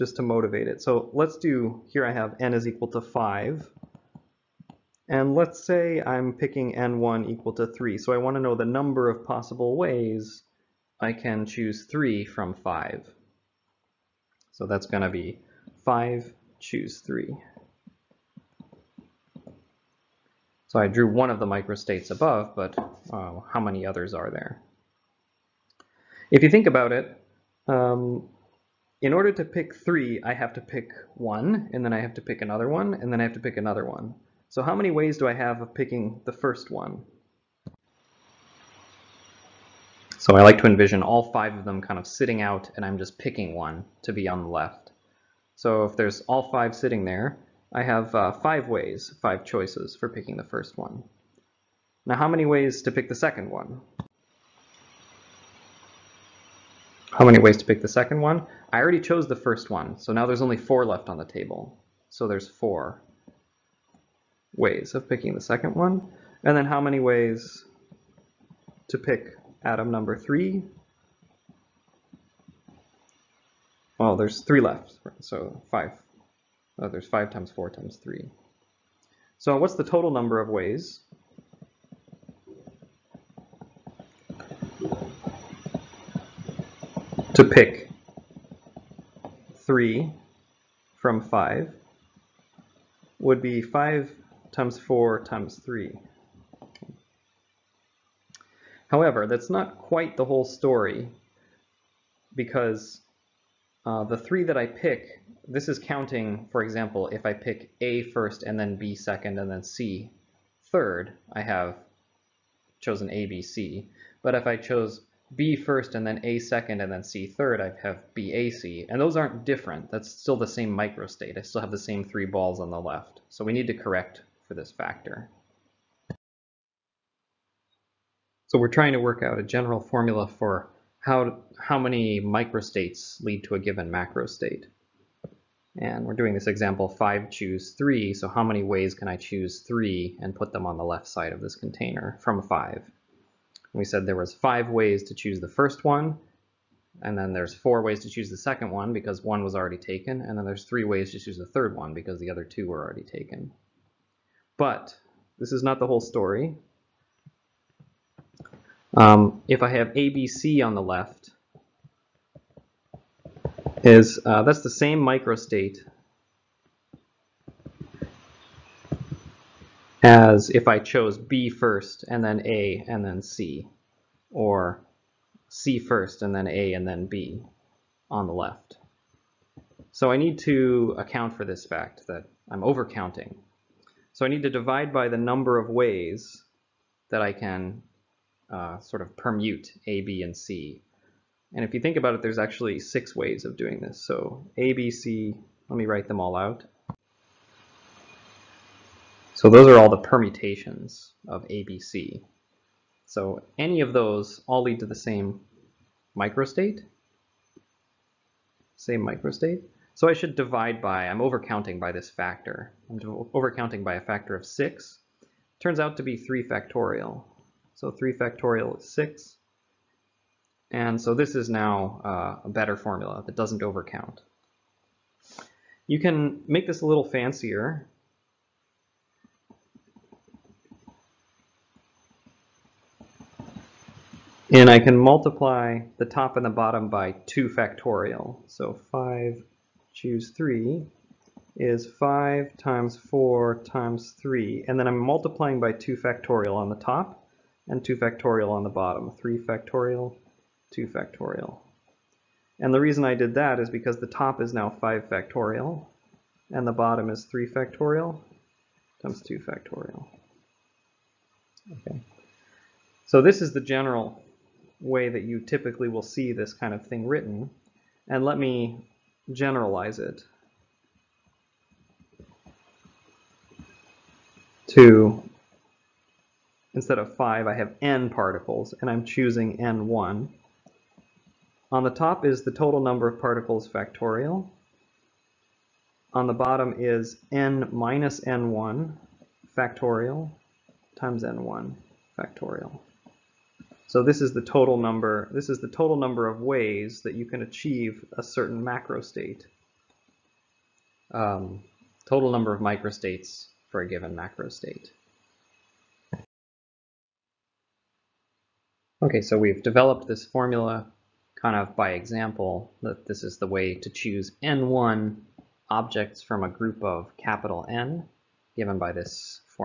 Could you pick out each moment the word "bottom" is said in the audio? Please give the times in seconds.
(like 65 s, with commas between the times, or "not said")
236 s, 248 s, 256 s, 286 s.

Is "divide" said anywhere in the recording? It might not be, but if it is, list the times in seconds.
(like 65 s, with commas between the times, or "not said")
184 s, 210 s.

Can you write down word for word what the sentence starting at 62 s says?
So there's four ways of picking the second one.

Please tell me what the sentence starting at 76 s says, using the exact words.
Oh, there's five times four times three.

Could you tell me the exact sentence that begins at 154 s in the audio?
But this is not the whole story.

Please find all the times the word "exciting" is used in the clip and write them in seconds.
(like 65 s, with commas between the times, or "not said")
not said.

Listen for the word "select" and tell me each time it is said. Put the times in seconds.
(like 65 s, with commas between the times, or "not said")
not said.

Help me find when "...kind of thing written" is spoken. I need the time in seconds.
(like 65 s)
266 s.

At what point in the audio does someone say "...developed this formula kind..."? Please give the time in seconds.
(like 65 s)
309 s.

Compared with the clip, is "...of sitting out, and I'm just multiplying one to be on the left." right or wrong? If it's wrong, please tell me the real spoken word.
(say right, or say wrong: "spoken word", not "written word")
wrong: "picking", not "multiplying".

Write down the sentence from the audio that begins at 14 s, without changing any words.
So that's going to be 5, choose 3.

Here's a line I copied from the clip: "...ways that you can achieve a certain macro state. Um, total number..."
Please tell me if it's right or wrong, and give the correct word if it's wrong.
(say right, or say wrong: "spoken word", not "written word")
right.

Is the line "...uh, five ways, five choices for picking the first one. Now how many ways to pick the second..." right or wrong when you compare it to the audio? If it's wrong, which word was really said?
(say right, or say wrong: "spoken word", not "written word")
right.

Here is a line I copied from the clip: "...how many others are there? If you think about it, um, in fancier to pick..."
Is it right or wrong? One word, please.
wrong.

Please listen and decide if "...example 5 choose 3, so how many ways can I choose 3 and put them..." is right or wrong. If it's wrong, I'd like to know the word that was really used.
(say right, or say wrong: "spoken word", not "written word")
right.